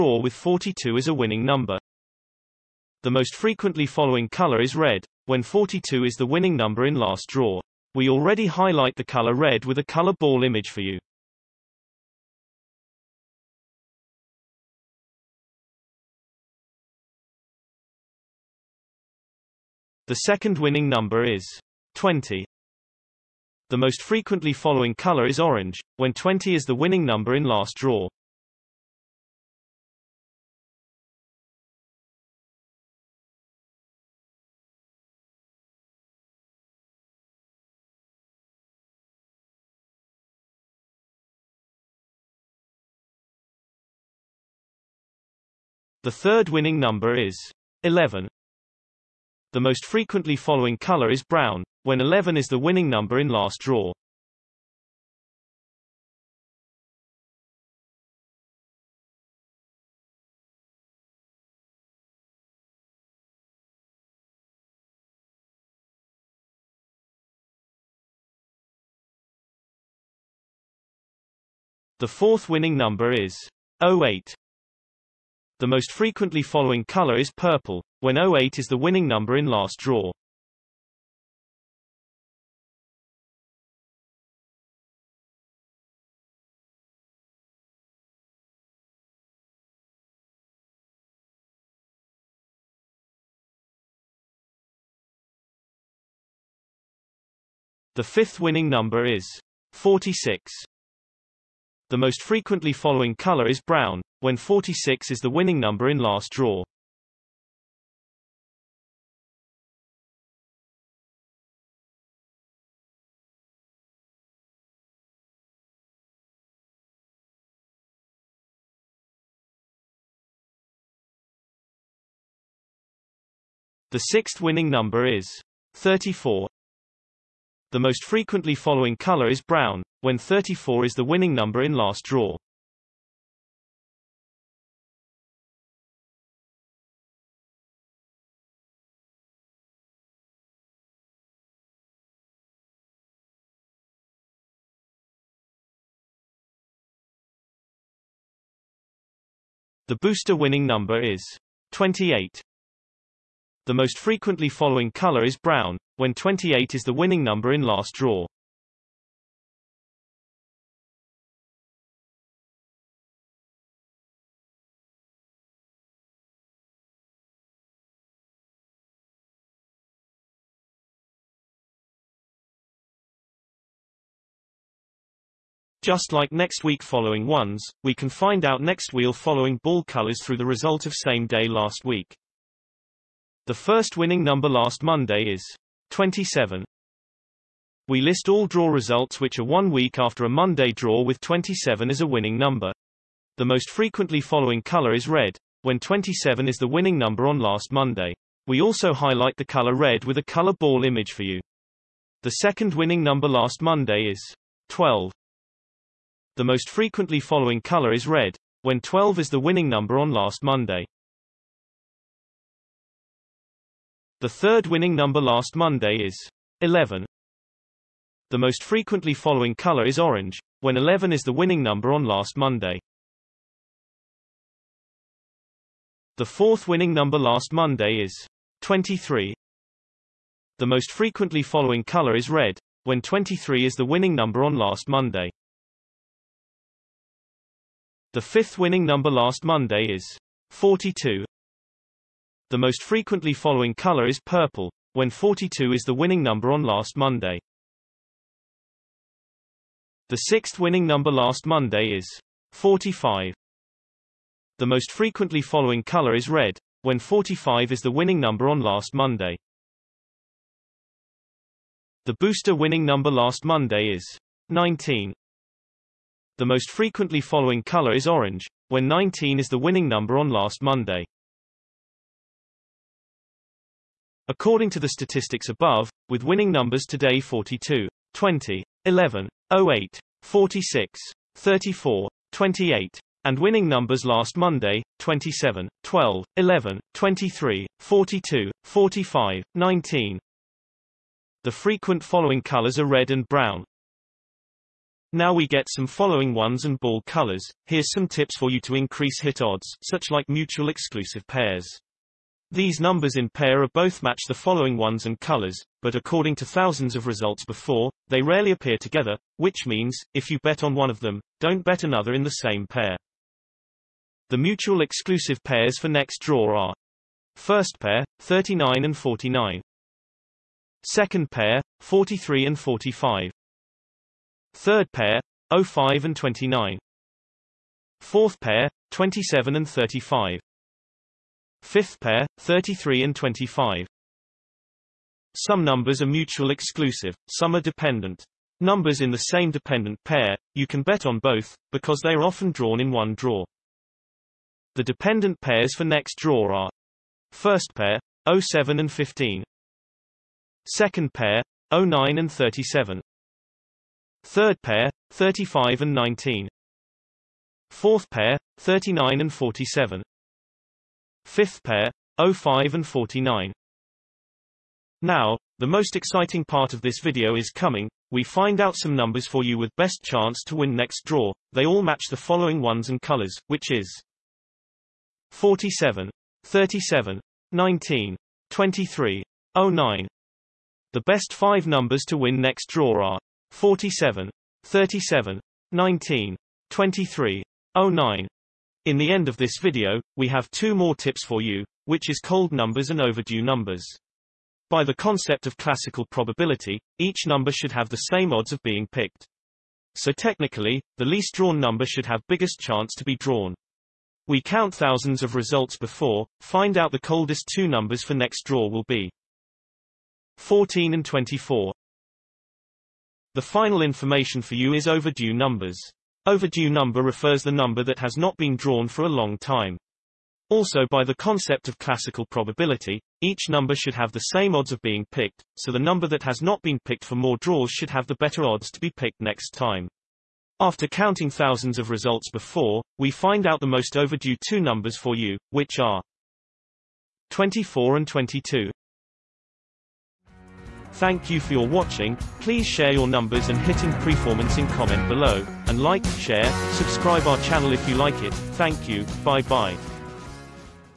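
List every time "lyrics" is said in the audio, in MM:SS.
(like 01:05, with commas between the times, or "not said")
not said.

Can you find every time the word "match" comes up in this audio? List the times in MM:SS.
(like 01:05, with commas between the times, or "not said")
05:04, 06:11.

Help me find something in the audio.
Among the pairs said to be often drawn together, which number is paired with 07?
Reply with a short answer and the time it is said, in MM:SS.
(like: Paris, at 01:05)
15, at 05:48.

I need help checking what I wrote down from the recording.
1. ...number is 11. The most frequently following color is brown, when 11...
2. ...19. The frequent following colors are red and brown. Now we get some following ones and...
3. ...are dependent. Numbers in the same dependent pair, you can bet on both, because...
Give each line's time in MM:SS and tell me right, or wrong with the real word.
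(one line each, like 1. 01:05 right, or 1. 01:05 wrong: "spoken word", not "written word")
1. 00:46 right
2. 04:49 right
3. 05:37 right.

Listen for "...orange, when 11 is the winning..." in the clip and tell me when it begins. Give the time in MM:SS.
03:39.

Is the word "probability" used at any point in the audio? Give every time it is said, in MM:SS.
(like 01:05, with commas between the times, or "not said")
06:36, 07:02.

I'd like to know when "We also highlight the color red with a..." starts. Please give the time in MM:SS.
03:18.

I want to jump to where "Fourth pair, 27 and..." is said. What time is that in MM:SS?
05:28.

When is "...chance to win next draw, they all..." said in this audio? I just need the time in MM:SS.
06:10.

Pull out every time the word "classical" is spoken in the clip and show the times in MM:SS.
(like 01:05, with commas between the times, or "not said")
06:35, 07:01.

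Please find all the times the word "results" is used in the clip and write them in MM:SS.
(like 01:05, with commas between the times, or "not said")
03:00, 03:08, 05:07, 06:45, 07:11.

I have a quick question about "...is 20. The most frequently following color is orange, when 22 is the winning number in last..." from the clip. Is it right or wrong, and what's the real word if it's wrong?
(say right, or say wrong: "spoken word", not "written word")
wrong: "20", not "22".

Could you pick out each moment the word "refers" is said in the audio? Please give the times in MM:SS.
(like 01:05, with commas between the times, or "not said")
06:57.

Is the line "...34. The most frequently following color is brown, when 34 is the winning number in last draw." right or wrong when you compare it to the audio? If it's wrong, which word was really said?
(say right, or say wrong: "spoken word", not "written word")
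right.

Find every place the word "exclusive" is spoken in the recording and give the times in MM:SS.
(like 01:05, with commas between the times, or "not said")
05:00, 05:14, 05:36.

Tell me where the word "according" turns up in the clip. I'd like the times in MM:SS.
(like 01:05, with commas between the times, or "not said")
04:34, 05:05.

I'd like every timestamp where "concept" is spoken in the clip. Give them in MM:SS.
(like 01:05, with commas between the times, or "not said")
06:34, 07:01.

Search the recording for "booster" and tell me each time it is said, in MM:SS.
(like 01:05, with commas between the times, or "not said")
02:29, 04:22.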